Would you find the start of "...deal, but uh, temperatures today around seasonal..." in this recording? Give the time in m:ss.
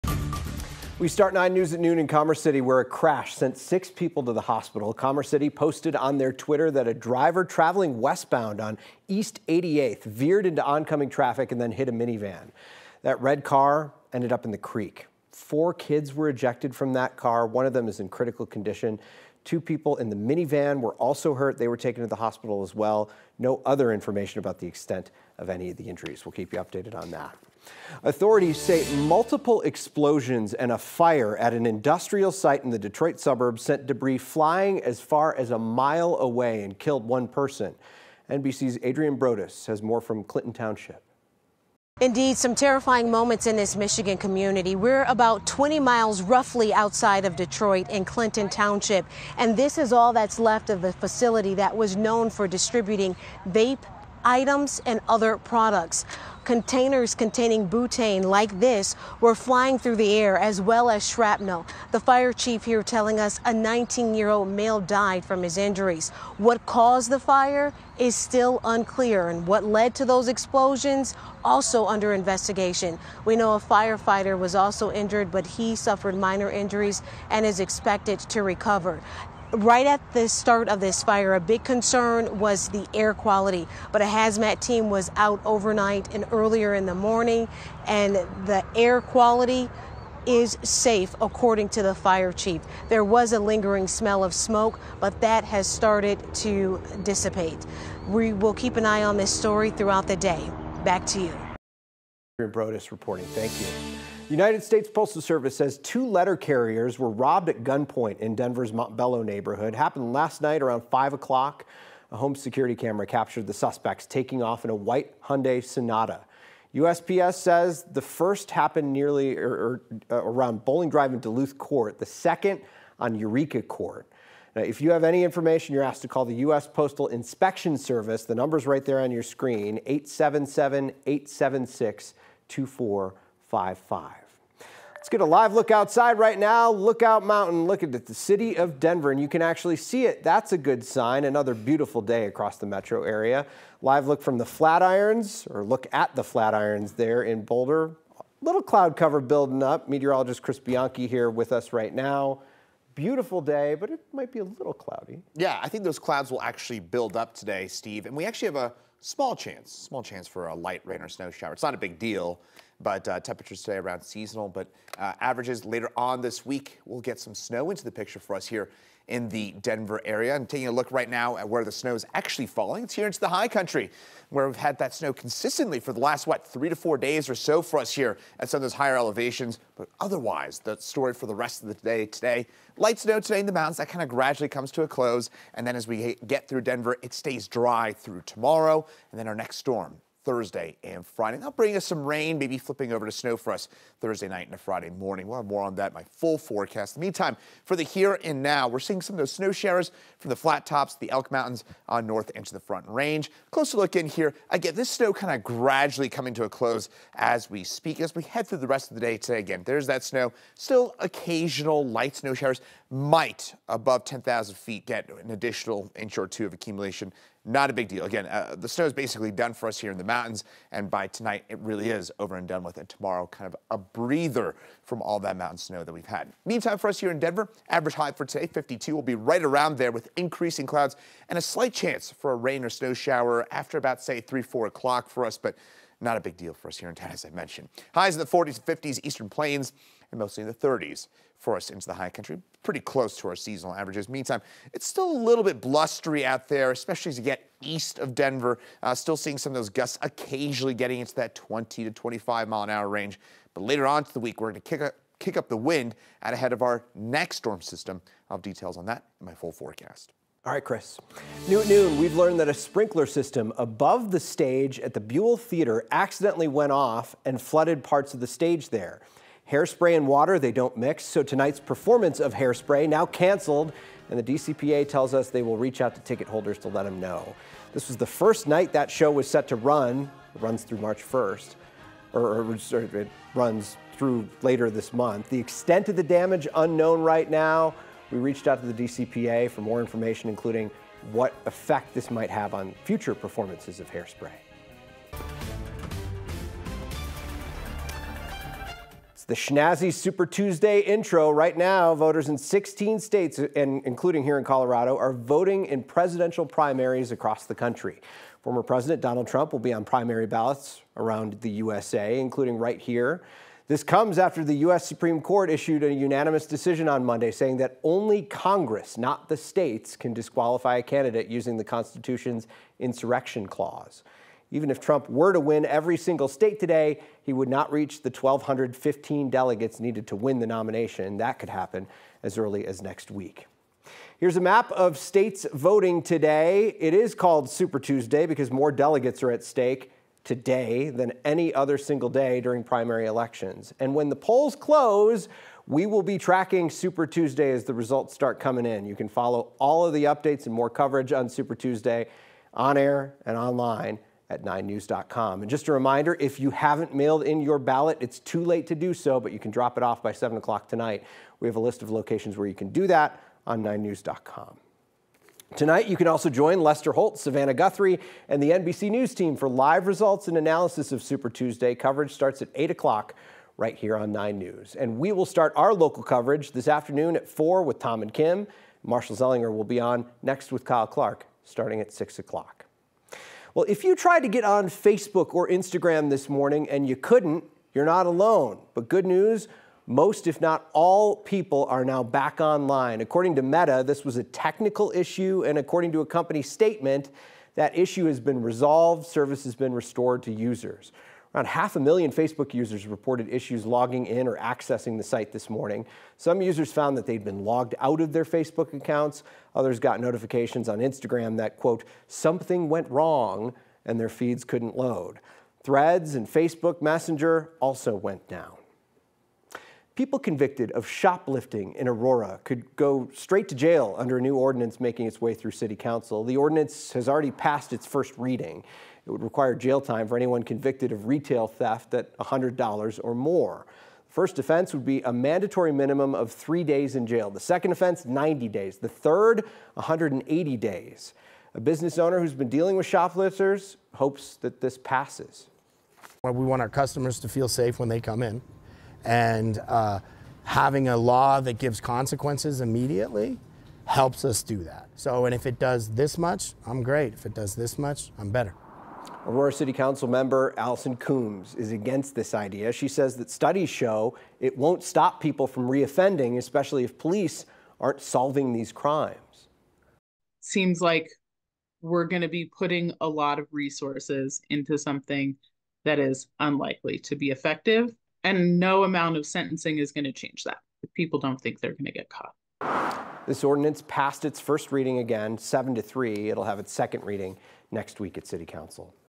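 2:41.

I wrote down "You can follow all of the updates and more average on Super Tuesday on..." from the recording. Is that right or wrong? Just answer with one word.
wrong.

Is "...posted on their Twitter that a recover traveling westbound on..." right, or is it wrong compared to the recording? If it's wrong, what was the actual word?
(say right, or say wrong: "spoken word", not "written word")
wrong: "driver", not "recover".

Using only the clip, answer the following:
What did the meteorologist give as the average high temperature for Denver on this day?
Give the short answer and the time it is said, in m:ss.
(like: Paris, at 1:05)
52, at 3:48.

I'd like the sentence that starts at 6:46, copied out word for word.
Some users found that they'd been logged out of their Facebook accounts.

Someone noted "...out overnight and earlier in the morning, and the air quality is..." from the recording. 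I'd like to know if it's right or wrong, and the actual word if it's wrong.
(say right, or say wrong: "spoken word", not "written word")
right.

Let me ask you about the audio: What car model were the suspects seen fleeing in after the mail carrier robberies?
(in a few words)
Hyundai Sonata.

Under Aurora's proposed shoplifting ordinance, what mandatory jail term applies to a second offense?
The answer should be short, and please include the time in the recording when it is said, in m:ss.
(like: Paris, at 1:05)
90 days, at 7:18.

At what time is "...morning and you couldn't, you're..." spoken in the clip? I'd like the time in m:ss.
6:26.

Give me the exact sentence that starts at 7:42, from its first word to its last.
She says that studies show it won't stop people from reoffending, especially if police aren't solving these crimes.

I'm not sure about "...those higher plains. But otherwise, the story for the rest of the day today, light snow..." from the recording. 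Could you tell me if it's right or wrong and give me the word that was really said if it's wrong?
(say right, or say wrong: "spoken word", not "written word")
wrong: "elevations", not "plains".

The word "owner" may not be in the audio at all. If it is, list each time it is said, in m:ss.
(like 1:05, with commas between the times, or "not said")
7:21.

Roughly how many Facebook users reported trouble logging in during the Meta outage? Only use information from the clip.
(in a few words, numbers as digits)
half a million.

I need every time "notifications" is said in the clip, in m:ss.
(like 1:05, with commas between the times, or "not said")
6:49.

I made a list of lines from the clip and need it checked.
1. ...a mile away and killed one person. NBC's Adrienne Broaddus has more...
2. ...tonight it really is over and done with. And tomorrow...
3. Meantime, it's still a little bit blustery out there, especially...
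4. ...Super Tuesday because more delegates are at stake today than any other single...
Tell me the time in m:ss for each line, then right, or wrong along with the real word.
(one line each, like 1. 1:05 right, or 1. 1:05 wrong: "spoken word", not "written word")
1. 0:35 right
2. 3:41 right
3. 4:04 right
4. 5:37 right.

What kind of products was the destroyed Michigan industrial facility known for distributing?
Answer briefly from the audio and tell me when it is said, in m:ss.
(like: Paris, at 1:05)
vape items, at 0:53.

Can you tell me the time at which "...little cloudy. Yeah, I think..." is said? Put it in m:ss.
2:34.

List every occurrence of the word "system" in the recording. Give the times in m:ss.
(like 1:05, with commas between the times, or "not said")
4:17, 4:23.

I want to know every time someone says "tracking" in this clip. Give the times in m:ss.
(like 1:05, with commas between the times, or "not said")
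5:46.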